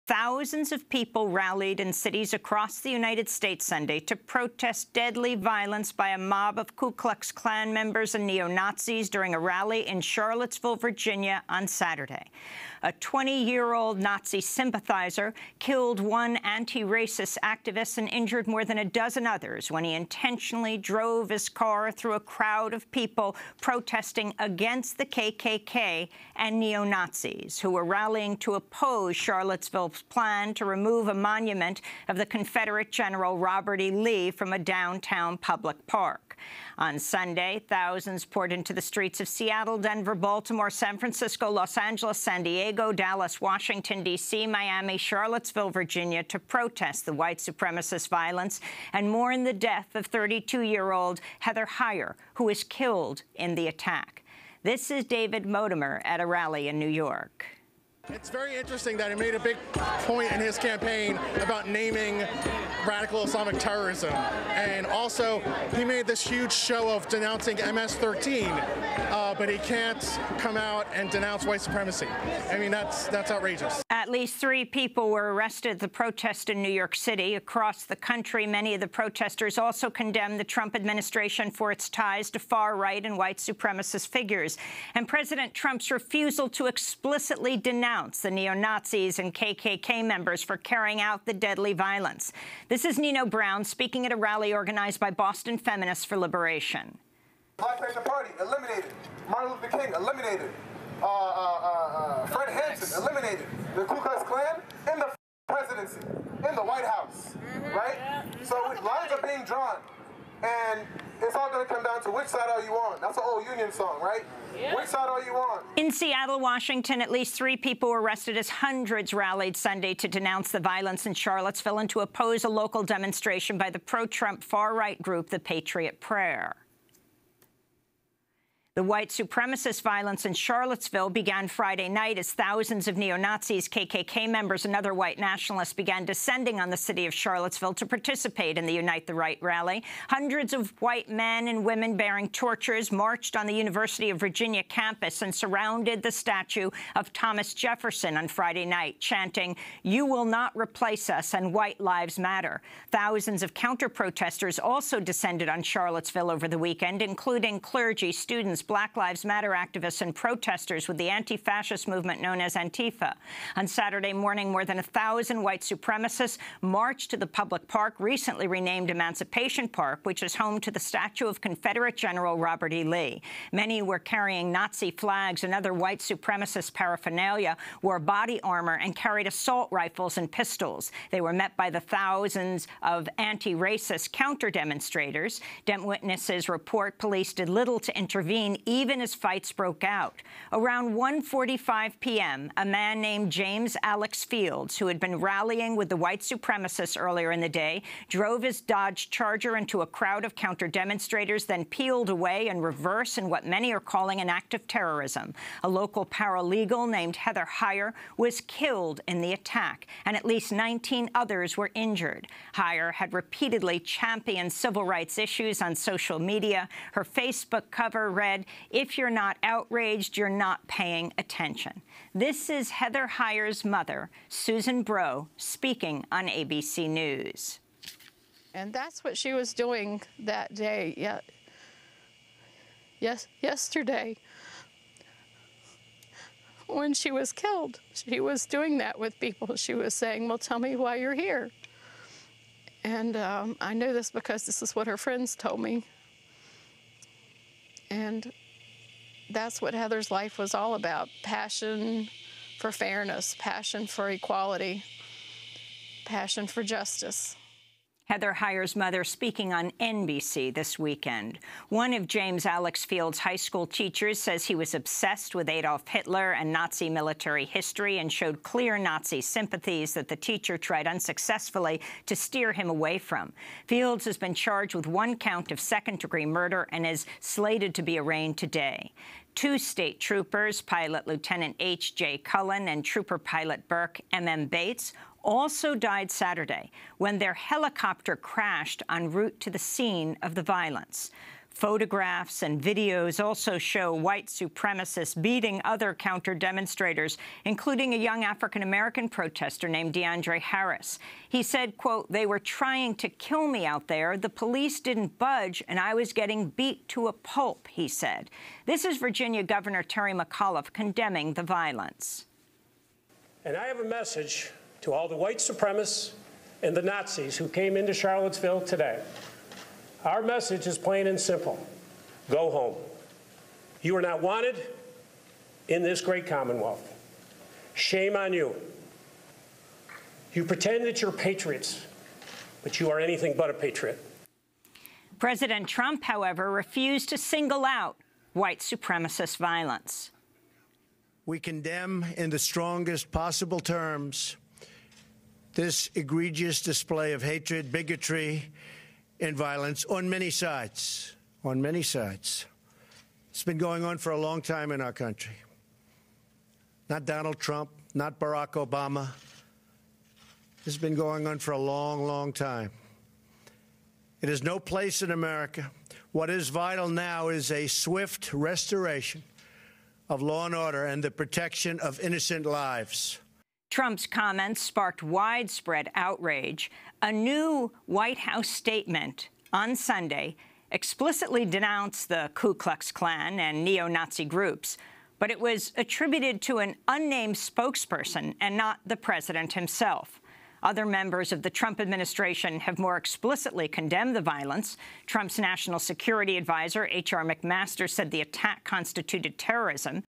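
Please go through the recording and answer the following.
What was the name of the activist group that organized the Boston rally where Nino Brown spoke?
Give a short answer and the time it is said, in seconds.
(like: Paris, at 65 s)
Boston Feminists for Liberation, at 95 s.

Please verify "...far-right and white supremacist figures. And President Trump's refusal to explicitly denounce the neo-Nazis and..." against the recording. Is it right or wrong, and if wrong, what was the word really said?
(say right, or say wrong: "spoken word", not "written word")
right.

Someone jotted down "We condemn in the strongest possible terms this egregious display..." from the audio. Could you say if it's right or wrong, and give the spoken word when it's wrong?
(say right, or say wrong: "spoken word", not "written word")
right.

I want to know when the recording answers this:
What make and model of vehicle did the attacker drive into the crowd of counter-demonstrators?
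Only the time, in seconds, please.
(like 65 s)
198 s.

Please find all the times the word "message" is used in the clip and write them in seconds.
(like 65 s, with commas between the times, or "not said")
313 s, 320 s.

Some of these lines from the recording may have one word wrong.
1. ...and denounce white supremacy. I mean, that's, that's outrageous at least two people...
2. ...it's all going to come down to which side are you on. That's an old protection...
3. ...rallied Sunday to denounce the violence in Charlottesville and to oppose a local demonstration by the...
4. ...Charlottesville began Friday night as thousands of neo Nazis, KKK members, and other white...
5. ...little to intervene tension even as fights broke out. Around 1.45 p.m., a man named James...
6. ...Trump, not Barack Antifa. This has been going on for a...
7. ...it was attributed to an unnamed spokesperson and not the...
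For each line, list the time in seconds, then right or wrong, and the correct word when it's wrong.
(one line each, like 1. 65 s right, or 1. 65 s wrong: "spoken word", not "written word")
1. 70 s wrong: "three", not "two"
2. 111 s wrong: "union", not "protection"
3. 119 s right
4. 130 s right
5. 187 s right
6. 357 s wrong: "Obama", not "Antifa"
7. 385 s right.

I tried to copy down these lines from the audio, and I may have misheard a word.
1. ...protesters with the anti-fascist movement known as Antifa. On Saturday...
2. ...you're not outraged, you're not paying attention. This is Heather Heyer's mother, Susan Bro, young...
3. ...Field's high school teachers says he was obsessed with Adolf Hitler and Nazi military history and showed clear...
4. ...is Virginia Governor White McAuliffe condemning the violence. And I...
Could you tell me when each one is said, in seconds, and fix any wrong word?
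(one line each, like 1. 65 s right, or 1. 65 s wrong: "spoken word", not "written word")
1. 160 s right
2. 218 s wrong: "speaking", not "young"
3. 262 s right
4. 308 s wrong: "Terry", not "White".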